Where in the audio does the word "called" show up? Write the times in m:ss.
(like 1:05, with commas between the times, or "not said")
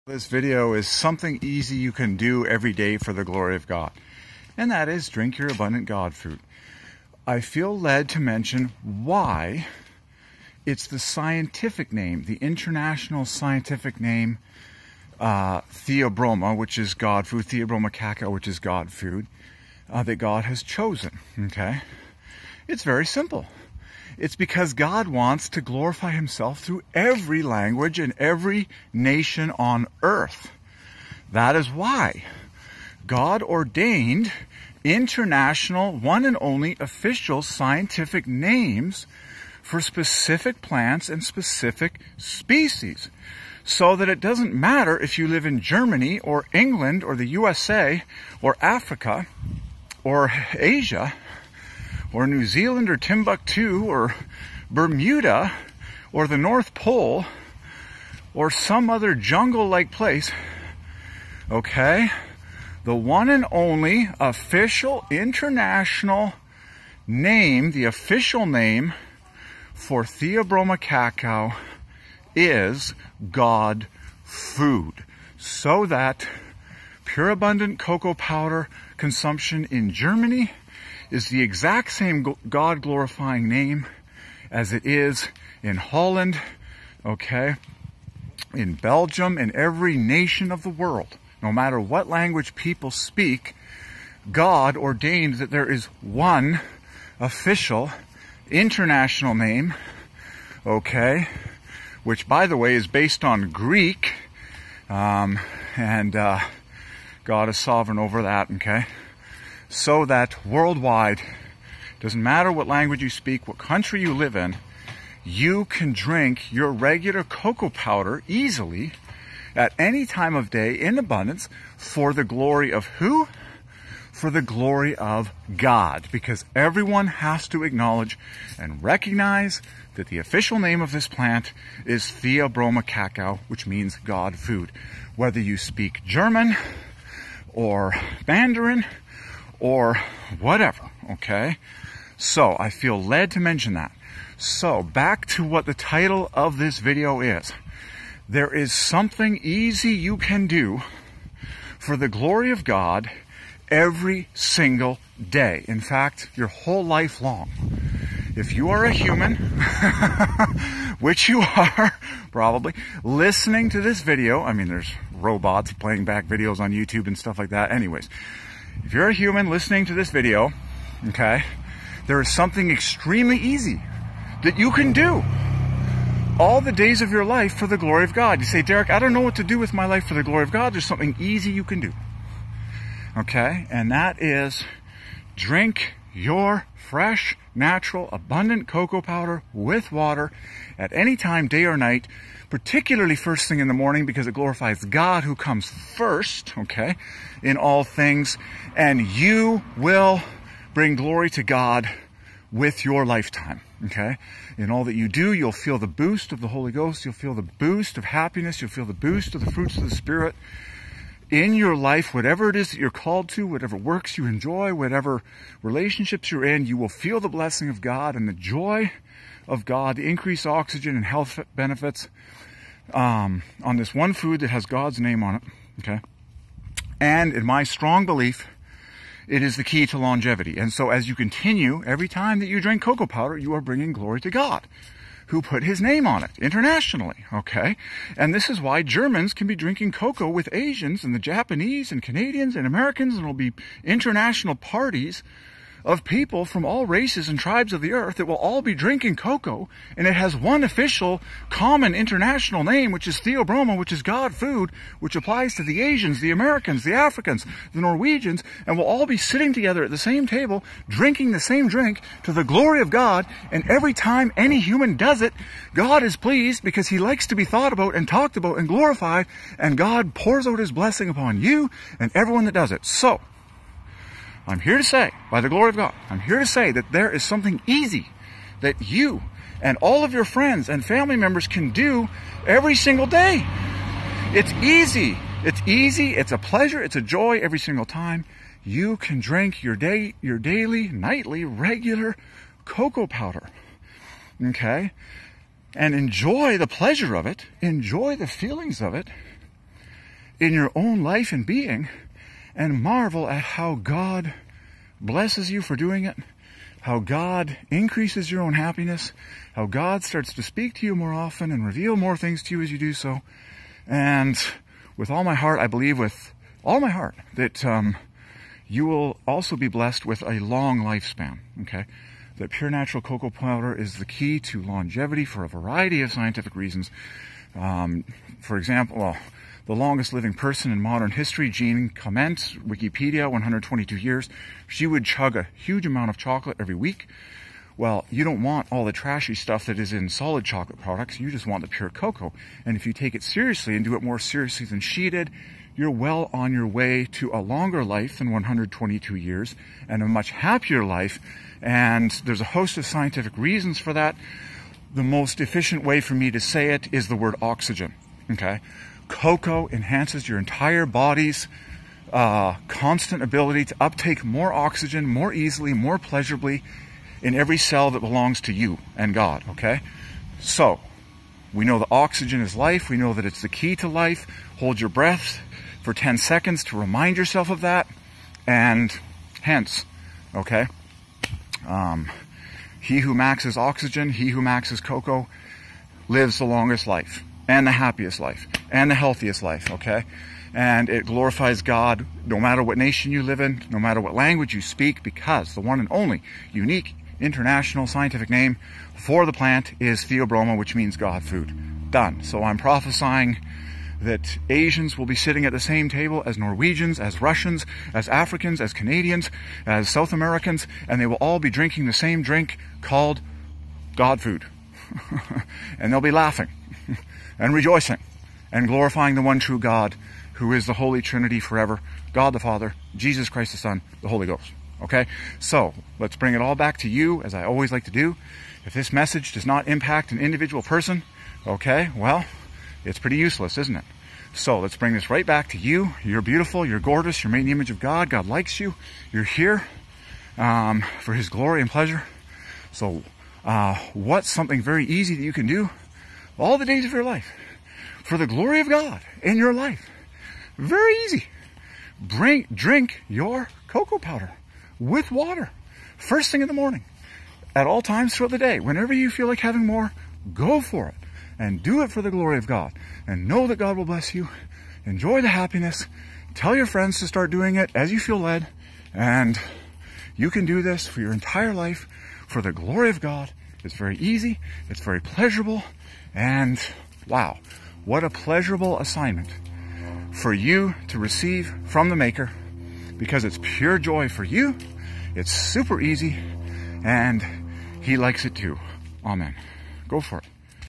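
3:32, 6:52.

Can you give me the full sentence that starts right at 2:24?
So back to what the title of this video is.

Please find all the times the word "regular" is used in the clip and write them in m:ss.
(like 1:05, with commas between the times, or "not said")
1:56, 4:51.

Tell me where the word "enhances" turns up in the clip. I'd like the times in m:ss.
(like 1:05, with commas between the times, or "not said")
5:59.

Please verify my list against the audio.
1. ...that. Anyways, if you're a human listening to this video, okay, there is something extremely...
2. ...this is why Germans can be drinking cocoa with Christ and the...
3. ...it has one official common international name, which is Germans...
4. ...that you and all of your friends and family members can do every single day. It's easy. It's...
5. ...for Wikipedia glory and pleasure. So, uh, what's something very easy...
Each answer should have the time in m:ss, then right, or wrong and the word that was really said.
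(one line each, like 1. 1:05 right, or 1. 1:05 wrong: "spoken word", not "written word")
1. 2:47 right
2. 3:58 wrong: "Asians", not "Christ"
3. 4:10 wrong: "Theobroma", not "Germans"
4. 4:38 right
5. 7:21 wrong: "His", not "Wikipedia".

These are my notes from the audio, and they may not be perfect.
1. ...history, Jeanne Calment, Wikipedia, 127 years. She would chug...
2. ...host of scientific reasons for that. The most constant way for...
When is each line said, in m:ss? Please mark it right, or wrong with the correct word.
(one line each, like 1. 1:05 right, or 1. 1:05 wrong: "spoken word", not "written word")
1. 5:31 wrong: "122", not "127"
2. 5:52 wrong: "efficient", not "constant".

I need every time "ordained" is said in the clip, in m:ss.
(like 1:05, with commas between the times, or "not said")
0:33, 1:34.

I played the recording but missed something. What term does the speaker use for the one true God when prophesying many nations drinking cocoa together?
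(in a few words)
Holy Trinity.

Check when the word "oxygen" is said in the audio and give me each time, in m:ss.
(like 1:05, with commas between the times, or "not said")
3:40, 5:57, 6:04, 6:11, 6:23.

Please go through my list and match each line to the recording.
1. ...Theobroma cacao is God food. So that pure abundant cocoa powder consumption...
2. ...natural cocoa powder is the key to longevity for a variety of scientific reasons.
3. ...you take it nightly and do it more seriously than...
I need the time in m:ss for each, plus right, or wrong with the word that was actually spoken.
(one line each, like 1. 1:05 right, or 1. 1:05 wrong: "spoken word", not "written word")
1. 1:10 right
2. 5:22 right
3. 5:42 wrong: "seriously", not "nightly".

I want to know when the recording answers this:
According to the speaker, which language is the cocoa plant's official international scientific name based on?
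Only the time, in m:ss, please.
1:43.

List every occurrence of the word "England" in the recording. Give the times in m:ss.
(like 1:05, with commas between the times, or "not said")
0:46.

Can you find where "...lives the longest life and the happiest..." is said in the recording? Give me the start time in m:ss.
6:26.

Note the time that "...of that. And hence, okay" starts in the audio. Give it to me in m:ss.
6:17.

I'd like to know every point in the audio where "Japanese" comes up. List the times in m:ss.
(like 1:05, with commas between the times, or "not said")
4:01.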